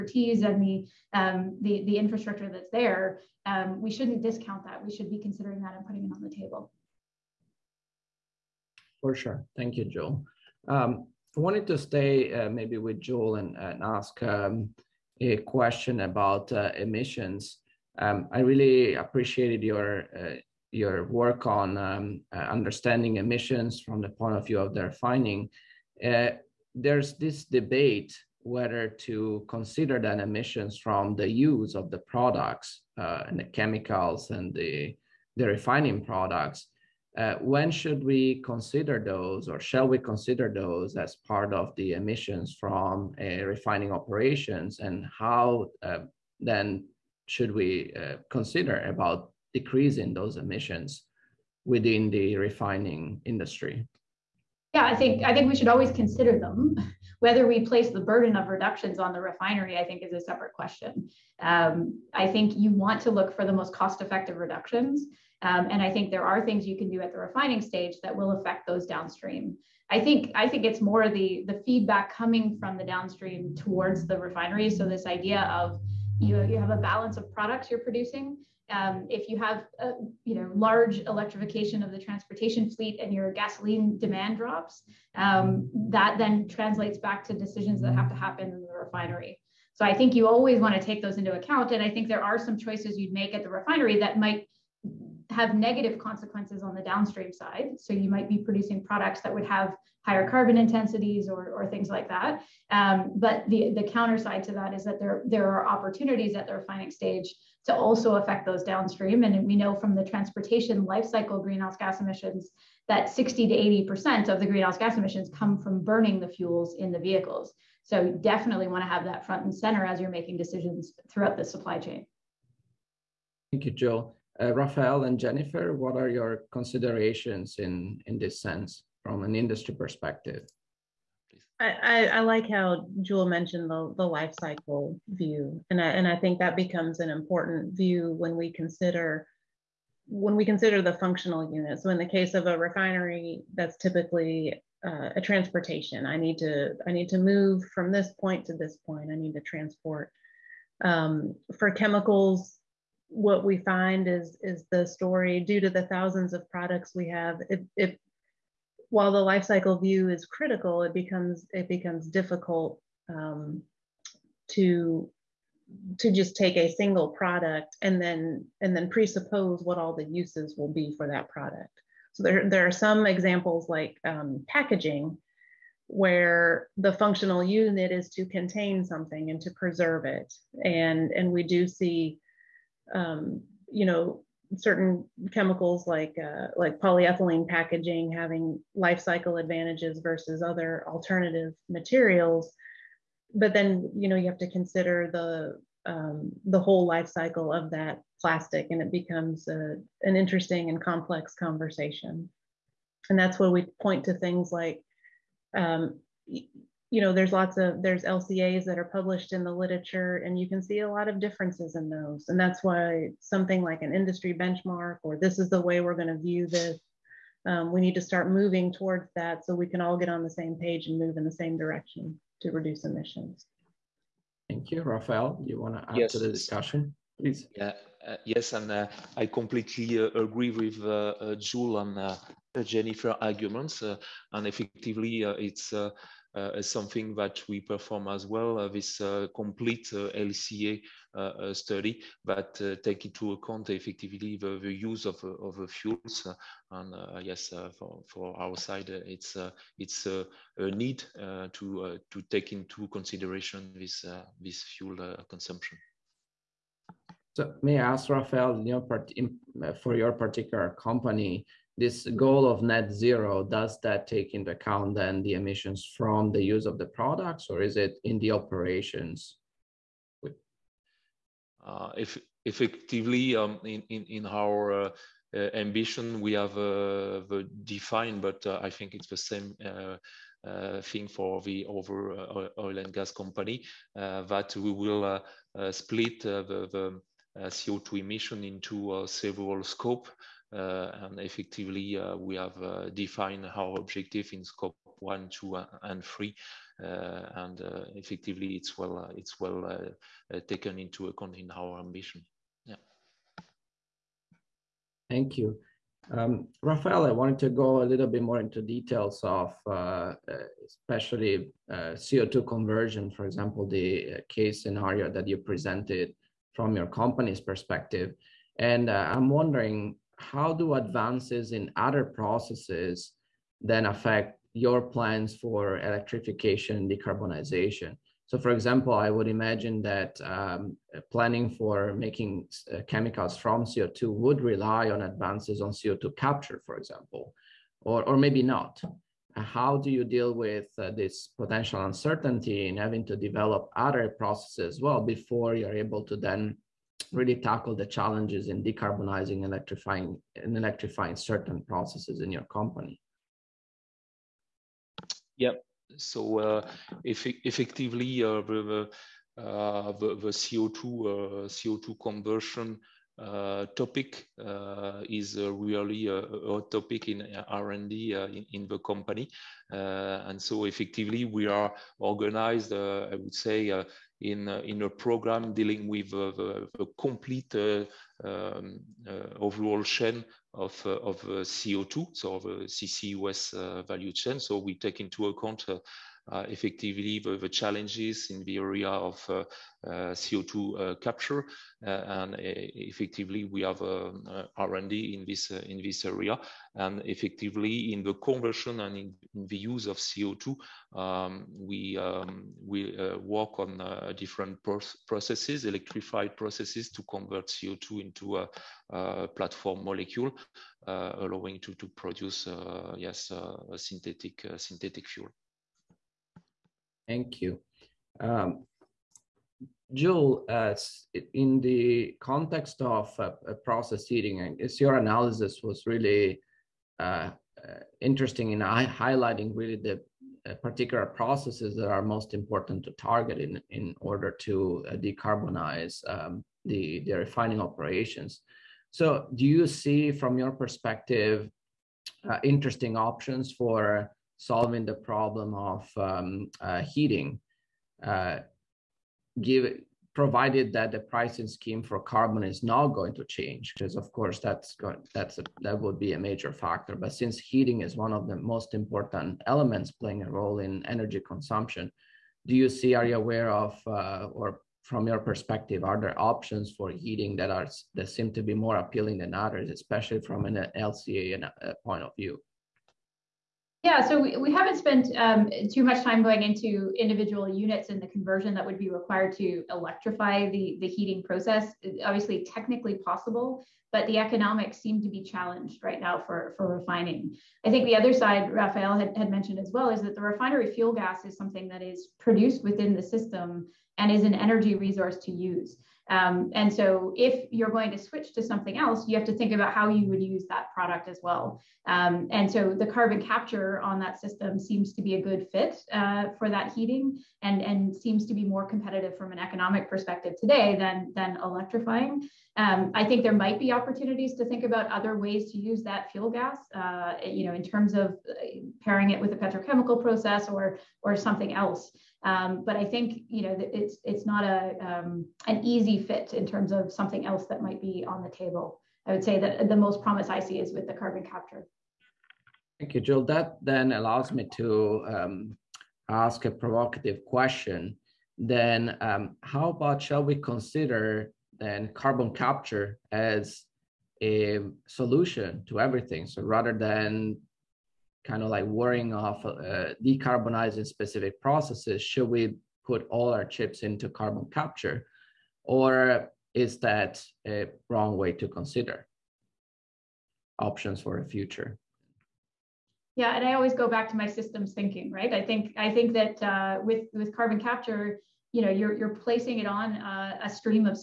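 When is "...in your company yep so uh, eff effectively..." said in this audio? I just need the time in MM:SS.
05:52.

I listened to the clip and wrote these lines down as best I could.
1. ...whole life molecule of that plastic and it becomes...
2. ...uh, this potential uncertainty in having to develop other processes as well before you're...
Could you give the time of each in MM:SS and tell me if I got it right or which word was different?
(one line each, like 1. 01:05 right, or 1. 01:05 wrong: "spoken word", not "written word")
1. 03:16 wrong: "cycle", not "molecule"
2. 05:40 right.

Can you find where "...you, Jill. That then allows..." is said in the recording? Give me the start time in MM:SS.
08:52.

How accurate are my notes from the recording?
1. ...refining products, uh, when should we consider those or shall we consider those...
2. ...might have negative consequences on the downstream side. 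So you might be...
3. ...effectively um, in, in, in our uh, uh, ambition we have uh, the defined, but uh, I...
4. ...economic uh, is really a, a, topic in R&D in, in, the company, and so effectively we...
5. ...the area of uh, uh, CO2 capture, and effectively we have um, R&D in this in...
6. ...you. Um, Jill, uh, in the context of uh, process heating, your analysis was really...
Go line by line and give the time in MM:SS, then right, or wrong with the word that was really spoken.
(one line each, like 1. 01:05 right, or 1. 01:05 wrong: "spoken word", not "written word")
1. 00:35 right
2. 01:34 right
3. 04:32 right
4. 06:03 wrong: "topic", not "economic"
5. 06:28 right
6. 06:57 right.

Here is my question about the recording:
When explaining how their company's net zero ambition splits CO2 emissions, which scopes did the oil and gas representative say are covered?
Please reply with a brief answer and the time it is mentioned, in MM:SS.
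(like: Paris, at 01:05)
scope one, two, and three, at 04:54.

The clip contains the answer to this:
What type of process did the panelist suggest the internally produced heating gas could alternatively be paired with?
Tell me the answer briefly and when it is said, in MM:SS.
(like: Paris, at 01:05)
petrochemical process, at 08:39.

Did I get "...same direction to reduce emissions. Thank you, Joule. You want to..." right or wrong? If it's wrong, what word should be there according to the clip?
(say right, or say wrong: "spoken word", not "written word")
wrong: "Rafael", not "Joule".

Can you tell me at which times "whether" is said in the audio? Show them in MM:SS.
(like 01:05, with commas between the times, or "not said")
00:28, 00:57.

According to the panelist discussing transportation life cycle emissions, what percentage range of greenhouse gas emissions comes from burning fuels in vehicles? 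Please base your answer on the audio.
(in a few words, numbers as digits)
60 to 80%.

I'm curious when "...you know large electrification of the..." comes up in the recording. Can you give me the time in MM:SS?
01:20.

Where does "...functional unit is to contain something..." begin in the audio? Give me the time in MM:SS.
02:56.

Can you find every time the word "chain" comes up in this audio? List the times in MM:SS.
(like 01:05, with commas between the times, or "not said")
02:01, 06:19, 06:24.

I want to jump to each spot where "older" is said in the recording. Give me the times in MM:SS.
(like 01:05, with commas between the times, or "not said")
not said.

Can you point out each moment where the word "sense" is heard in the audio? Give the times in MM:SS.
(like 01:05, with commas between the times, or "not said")
02:08.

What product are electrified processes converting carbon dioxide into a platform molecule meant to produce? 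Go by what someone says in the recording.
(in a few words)
synthetic fuel.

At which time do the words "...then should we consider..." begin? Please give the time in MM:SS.
00:46.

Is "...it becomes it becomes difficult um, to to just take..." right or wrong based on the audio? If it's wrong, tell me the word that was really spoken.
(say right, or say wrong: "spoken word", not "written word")
right.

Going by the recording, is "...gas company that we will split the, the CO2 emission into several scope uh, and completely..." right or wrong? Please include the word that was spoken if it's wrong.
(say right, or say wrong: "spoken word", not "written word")
wrong: "effectively", not "completely".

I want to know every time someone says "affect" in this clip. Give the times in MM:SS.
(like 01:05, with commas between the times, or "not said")
01:08, 01:48, 05:23.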